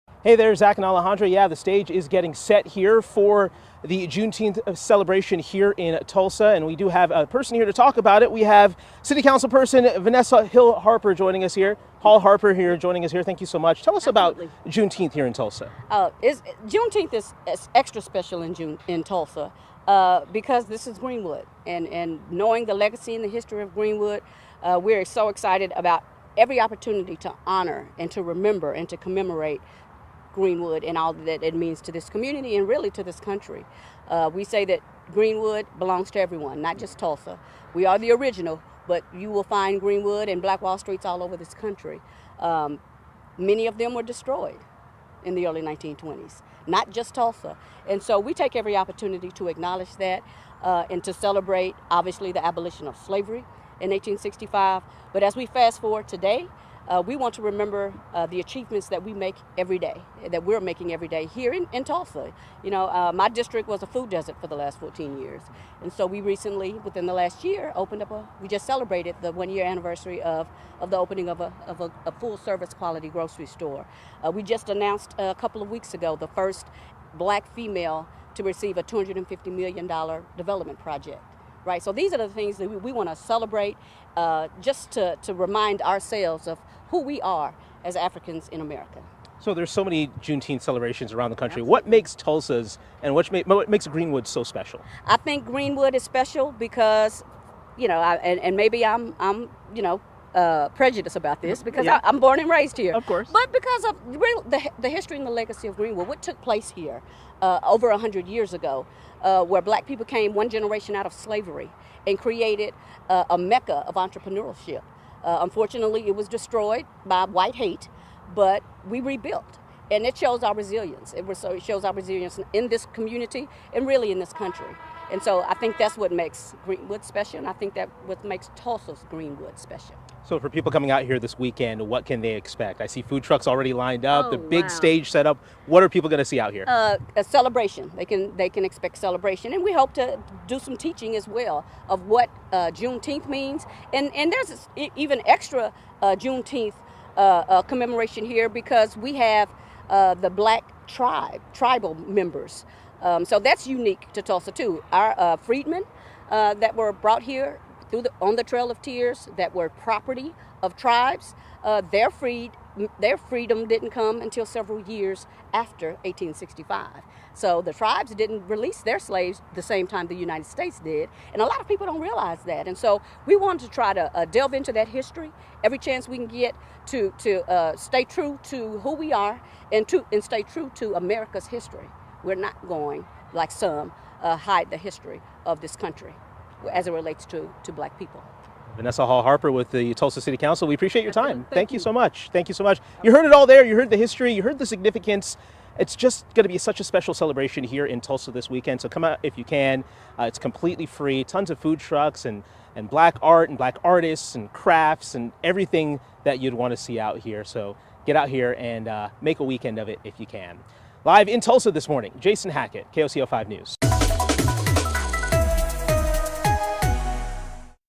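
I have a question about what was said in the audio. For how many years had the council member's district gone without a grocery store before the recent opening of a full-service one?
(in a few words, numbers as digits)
14 years.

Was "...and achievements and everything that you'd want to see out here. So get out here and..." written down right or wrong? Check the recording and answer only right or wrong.
wrong.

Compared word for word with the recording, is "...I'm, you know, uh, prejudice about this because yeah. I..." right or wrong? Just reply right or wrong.
right.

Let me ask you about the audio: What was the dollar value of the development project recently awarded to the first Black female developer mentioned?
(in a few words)
$250 million.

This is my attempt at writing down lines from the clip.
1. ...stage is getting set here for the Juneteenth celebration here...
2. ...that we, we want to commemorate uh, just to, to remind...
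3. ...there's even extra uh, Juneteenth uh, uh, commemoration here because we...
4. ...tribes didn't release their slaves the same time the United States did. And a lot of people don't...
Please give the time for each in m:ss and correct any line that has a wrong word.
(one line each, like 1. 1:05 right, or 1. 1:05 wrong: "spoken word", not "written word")
1. 0:01 right
2. 1:22 wrong: "celebrate", not "commemorate"
3. 2:24 right
4. 2:47 right.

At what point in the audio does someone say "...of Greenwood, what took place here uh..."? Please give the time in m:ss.
1:45.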